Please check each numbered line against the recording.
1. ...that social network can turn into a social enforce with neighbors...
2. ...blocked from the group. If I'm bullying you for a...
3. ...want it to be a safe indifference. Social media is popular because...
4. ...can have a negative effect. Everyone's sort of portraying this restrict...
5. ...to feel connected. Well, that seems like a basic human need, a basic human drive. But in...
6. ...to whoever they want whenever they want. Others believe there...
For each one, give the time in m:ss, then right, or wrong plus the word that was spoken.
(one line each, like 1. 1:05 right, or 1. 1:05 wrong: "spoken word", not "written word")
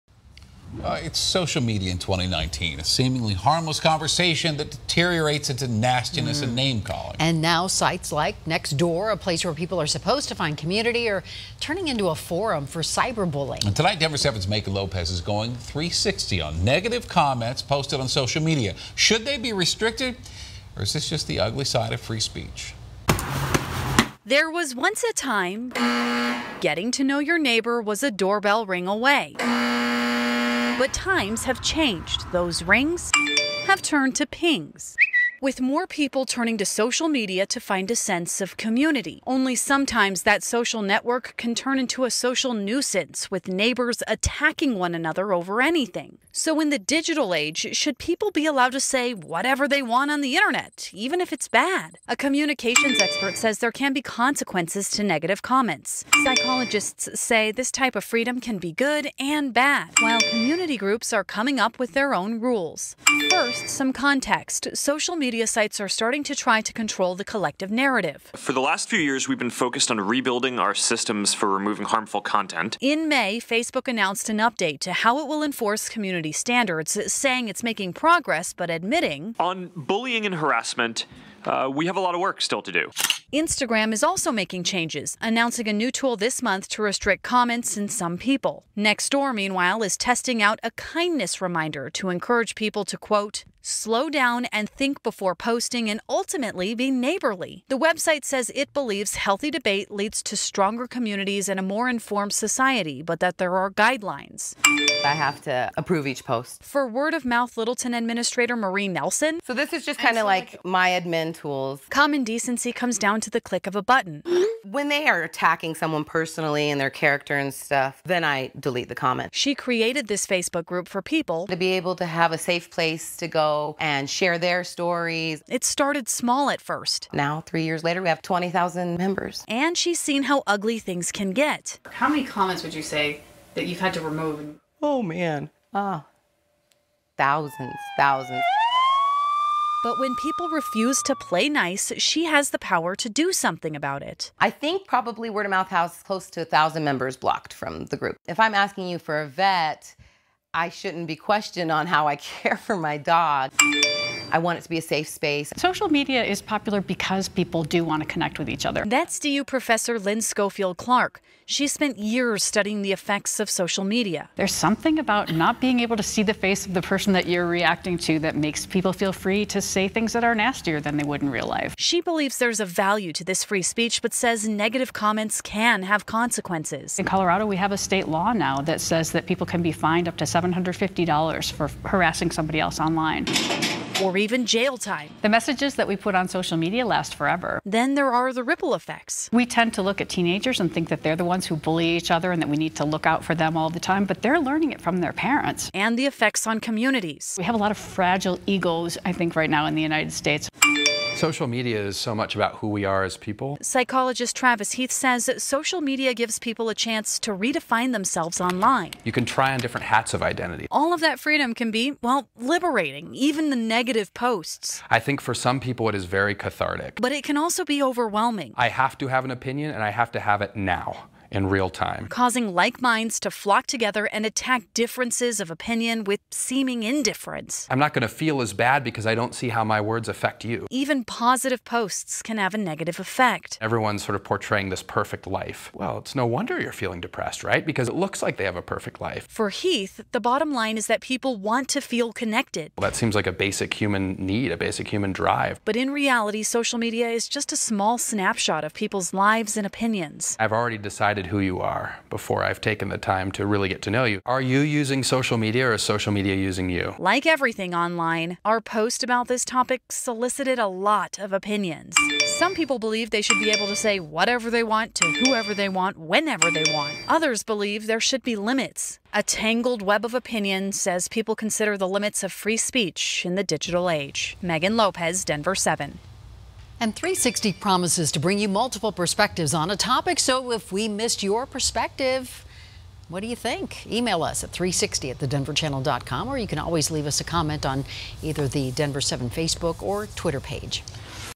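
1. 0:40 wrong: "nuisance", not "enforce"
2. 2:27 wrong: "asking", not "bullying"
3. 2:34 wrong: "space", not "indifference"
4. 3:52 wrong: "perfect", not "restrict"
5. 4:01 right
6. 4:24 right.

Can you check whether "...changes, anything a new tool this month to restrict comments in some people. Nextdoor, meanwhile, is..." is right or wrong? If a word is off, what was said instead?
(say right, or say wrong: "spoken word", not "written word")
wrong: "announcing", not "anything".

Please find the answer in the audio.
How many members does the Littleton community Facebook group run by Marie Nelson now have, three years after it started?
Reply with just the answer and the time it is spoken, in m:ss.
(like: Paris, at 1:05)
20,000, at 2:08.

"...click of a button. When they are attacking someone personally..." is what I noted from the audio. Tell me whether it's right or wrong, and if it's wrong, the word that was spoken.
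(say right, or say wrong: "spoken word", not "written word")
right.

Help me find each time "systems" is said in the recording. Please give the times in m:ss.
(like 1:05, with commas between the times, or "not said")
1:10.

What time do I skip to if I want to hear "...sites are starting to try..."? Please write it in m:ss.
1:05.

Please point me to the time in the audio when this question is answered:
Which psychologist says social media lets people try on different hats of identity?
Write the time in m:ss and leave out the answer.
3:24.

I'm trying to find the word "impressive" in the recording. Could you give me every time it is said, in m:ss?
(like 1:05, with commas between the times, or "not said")
not said.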